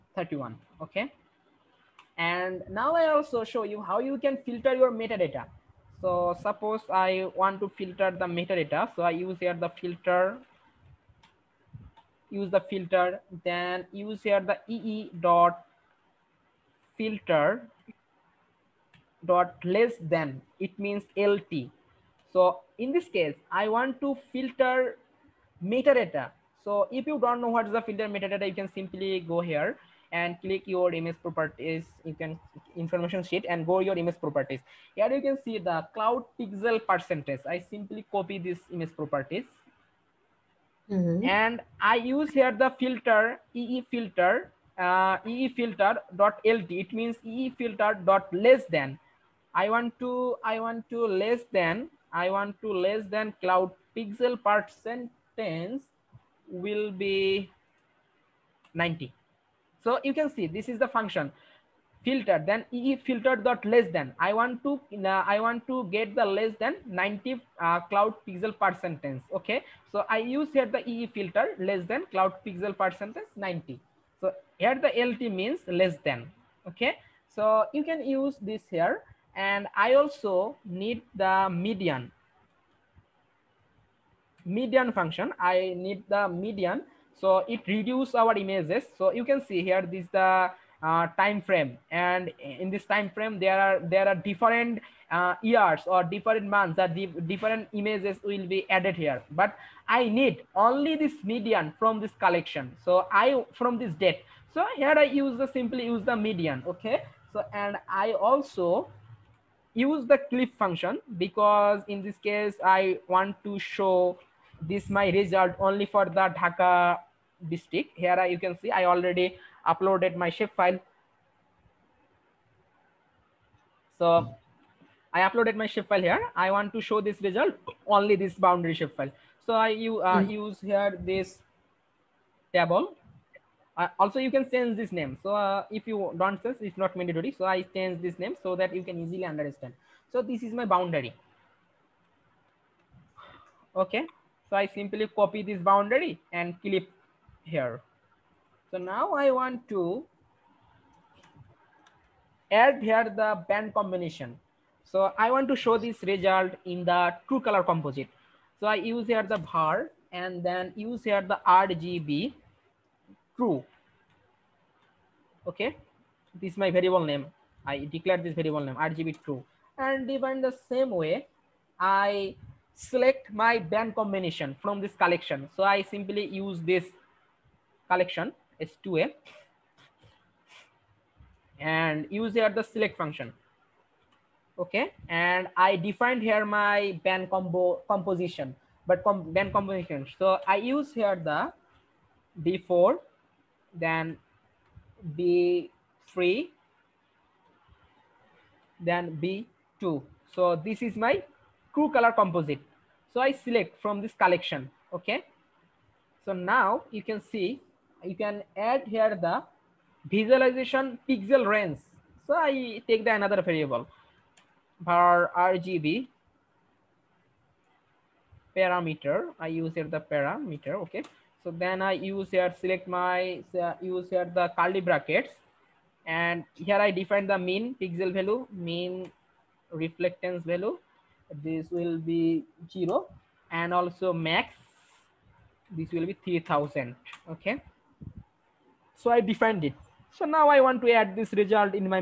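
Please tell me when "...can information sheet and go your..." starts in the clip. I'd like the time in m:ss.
0:32.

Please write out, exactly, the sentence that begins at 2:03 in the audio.
So I uploaded my shape file here.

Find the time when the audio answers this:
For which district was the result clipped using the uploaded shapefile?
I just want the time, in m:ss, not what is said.
1:56.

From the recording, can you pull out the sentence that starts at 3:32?
So I take the another variable var RGB parameter.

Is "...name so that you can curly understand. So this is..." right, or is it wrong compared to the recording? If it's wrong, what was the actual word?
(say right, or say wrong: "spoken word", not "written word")
wrong: "easily", not "curly".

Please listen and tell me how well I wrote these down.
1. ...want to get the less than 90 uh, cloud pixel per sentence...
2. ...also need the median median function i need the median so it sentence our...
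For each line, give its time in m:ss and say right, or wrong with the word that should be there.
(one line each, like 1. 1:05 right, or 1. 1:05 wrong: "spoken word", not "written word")
1. 1:05 right
2. 1:20 wrong: "reduce", not "sentence".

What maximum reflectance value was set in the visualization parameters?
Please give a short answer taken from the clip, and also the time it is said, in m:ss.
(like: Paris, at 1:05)
3000, at 3:56.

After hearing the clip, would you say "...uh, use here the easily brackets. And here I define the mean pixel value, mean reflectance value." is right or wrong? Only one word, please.
wrong.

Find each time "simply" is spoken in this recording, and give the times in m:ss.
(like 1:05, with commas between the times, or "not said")
0:28, 0:37, 1:45, 2:24, 2:55.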